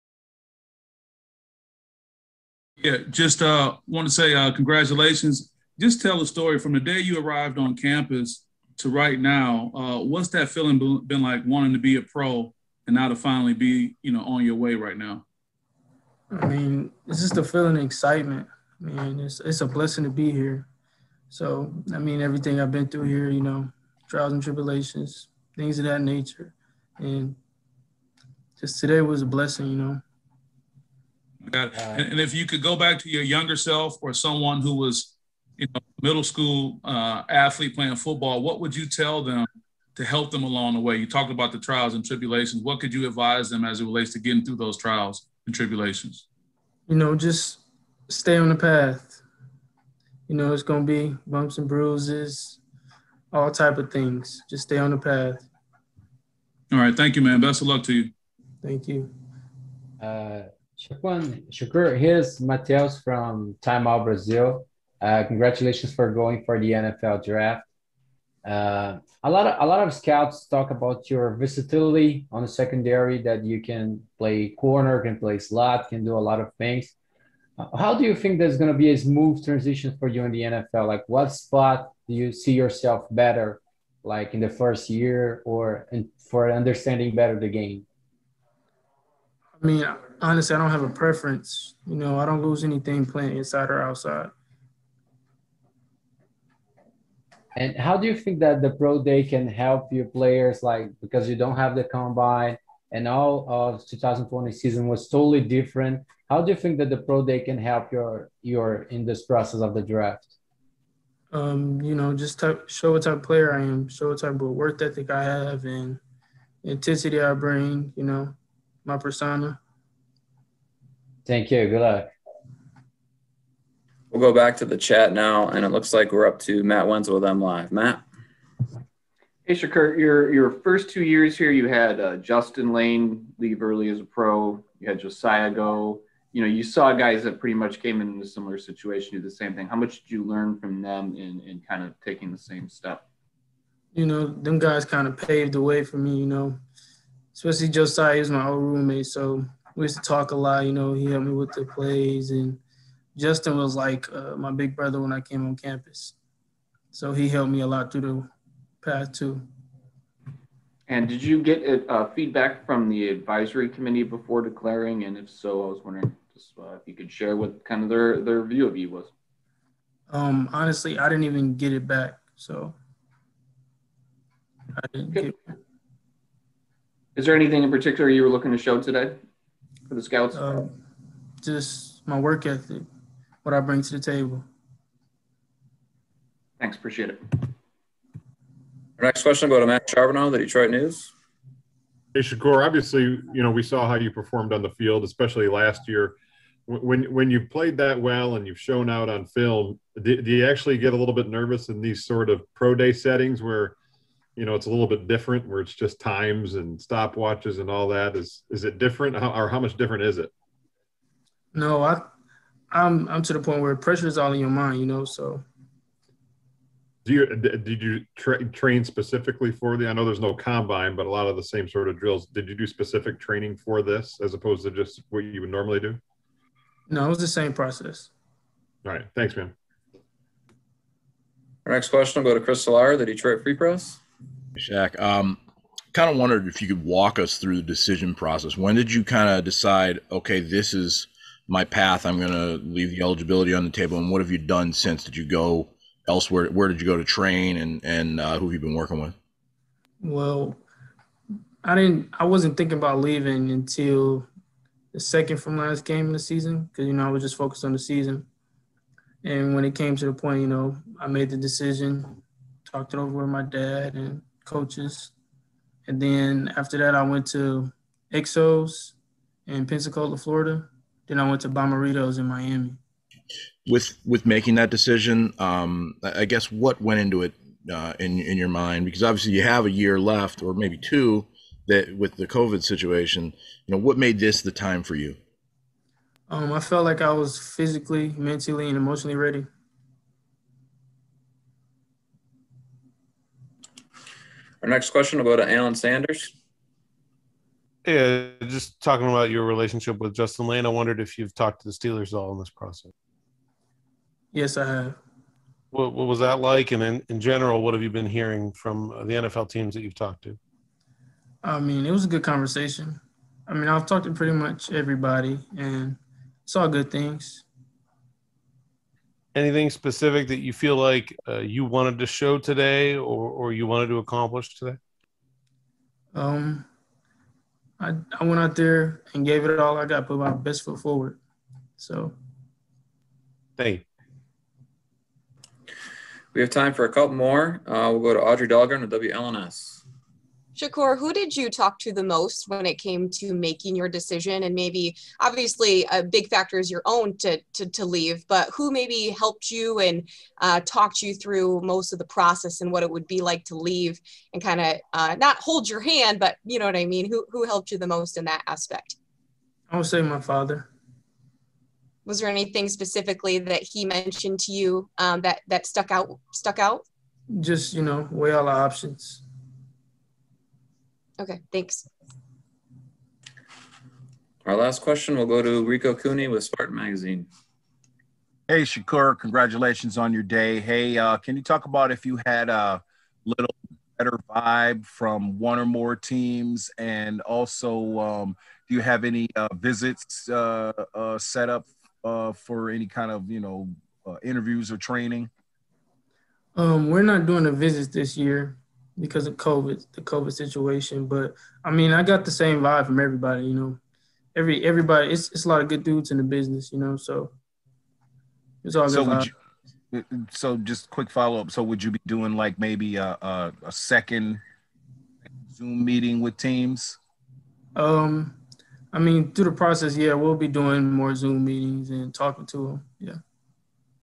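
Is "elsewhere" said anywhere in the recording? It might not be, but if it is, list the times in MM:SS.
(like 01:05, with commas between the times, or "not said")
04:06.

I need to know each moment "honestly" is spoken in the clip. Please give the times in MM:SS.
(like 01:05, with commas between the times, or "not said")
01:30, 02:50.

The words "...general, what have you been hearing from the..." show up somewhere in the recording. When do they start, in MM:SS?
05:07.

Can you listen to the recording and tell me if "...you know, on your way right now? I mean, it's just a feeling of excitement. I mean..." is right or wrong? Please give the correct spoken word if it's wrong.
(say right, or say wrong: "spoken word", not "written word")
right.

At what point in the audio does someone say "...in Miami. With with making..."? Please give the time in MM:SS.
04:32.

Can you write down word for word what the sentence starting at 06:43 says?
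You know, every everybody, it's it's a lot of good dudes in the business.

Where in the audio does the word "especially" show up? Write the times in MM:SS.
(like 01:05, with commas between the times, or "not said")
02:27, 03:15.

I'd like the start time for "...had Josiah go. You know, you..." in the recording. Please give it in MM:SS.
02:14.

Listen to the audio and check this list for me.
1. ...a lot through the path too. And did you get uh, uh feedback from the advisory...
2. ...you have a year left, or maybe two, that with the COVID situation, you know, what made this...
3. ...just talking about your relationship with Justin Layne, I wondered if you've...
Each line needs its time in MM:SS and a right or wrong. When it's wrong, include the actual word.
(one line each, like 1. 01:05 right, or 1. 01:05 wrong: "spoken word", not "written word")
1. 02:37 right
2. 04:39 right
3. 04:58 right.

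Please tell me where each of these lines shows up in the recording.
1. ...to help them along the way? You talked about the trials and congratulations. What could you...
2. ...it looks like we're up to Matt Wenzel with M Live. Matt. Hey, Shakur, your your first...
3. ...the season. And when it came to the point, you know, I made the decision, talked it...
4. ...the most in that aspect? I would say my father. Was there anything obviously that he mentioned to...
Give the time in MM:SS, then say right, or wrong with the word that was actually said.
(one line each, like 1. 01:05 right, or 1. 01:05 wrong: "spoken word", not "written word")
1. 00:39 wrong: "tribulations", not "congratulations"
2. 02:05 right
3. 04:17 right
4. 05:57 wrong: "specifically", not "obviously".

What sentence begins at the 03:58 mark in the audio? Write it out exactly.
When did you kind of decide, okay, this is my path?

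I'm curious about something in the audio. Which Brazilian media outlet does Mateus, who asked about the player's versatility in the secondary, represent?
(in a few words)
Time Out Brazil.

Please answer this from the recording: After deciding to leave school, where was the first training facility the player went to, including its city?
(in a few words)
Exos in Pensacola.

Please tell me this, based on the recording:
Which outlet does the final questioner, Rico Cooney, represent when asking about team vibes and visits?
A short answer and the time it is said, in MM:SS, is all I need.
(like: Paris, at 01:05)
Spartan Magazine, at 06:16.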